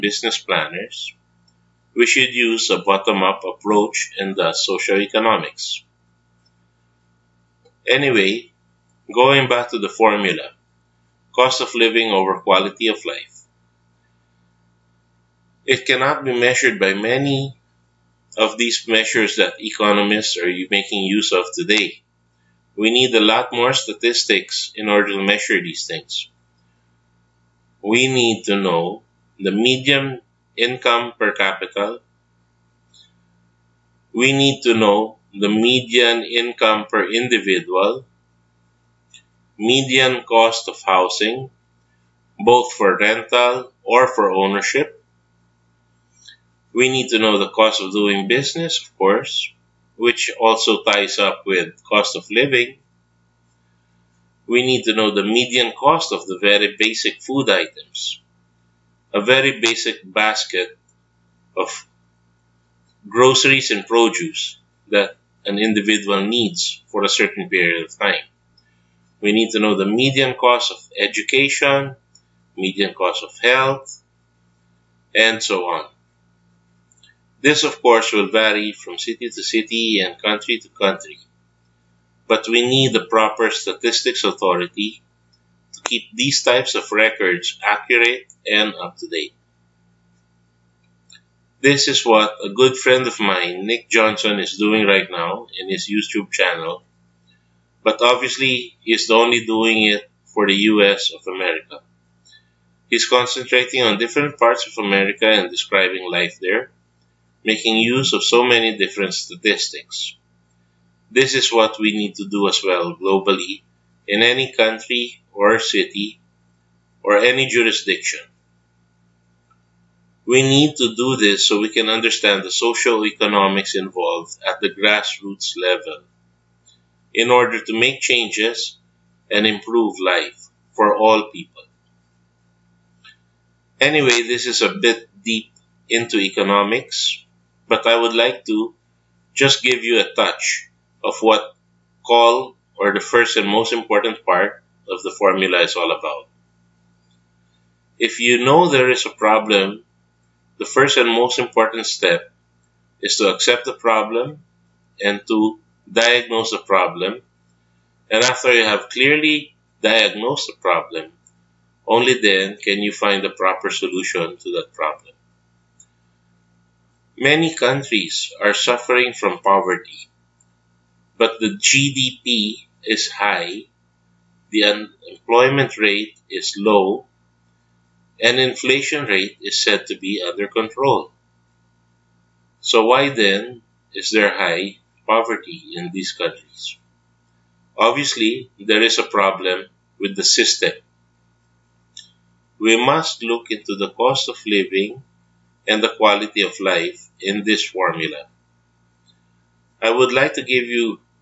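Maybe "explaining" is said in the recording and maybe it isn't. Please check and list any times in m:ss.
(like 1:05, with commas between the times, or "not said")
not said.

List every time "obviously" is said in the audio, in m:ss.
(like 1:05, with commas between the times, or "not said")
1:38, 3:07.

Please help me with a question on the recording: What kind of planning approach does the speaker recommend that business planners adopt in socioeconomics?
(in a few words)
bottom up approach.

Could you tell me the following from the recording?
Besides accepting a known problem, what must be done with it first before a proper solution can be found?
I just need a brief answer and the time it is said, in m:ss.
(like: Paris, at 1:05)
diagnose the problem, at 2:35.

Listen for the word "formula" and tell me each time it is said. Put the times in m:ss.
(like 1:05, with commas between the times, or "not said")
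0:10, 2:25, 3:17.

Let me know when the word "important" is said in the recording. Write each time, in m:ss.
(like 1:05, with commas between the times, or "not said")
2:23, 2:31.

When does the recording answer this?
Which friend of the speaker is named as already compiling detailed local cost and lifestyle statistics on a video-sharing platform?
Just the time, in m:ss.
1:33.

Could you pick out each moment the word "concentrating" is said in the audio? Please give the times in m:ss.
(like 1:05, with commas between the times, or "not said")
1:43.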